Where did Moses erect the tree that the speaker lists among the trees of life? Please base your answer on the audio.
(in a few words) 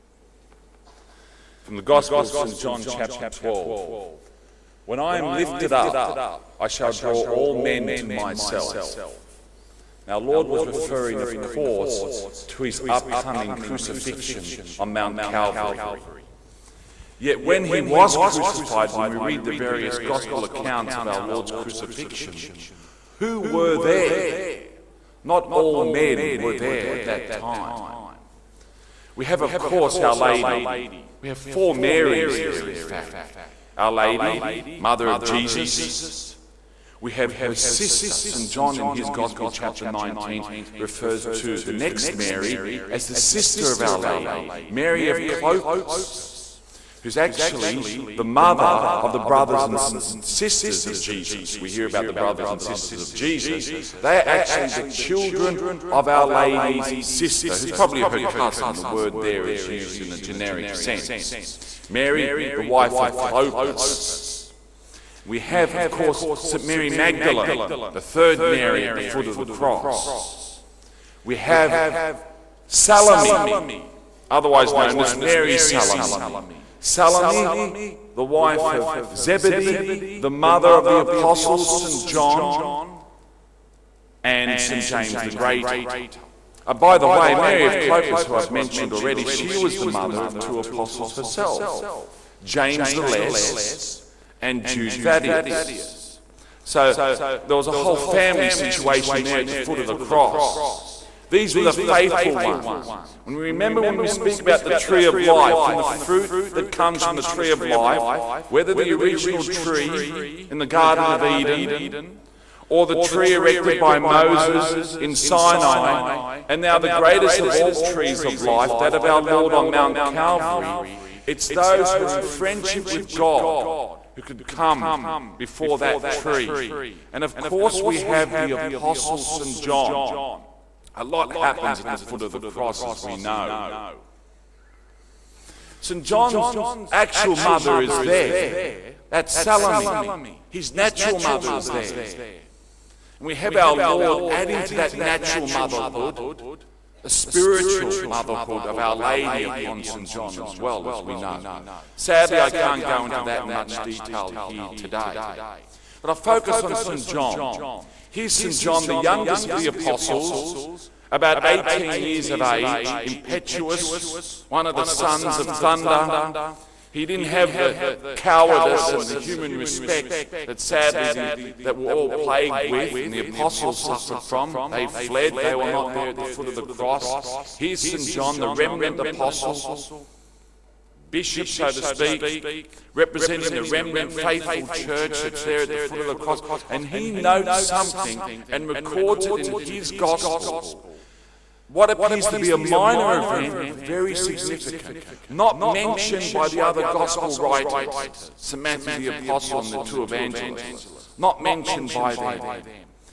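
Sinai.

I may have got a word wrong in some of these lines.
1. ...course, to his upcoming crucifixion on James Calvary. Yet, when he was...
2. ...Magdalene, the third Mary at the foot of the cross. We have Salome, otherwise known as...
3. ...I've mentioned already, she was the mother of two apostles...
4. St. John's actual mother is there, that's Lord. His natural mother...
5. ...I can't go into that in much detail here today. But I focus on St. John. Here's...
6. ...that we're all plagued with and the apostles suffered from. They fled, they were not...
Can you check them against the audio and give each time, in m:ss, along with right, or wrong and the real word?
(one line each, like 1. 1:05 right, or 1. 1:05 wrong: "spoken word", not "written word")
1. 0:11 wrong: "Mount", not "James"
2. 1:06 right
3. 1:28 right
4. 2:15 wrong: "Salome", not "Lord"
5. 2:32 right
6. 2:51 right.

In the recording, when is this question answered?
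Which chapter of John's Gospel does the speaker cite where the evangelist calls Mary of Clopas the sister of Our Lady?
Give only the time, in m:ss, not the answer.
0:39.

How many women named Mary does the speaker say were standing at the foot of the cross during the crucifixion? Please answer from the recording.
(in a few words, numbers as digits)
4.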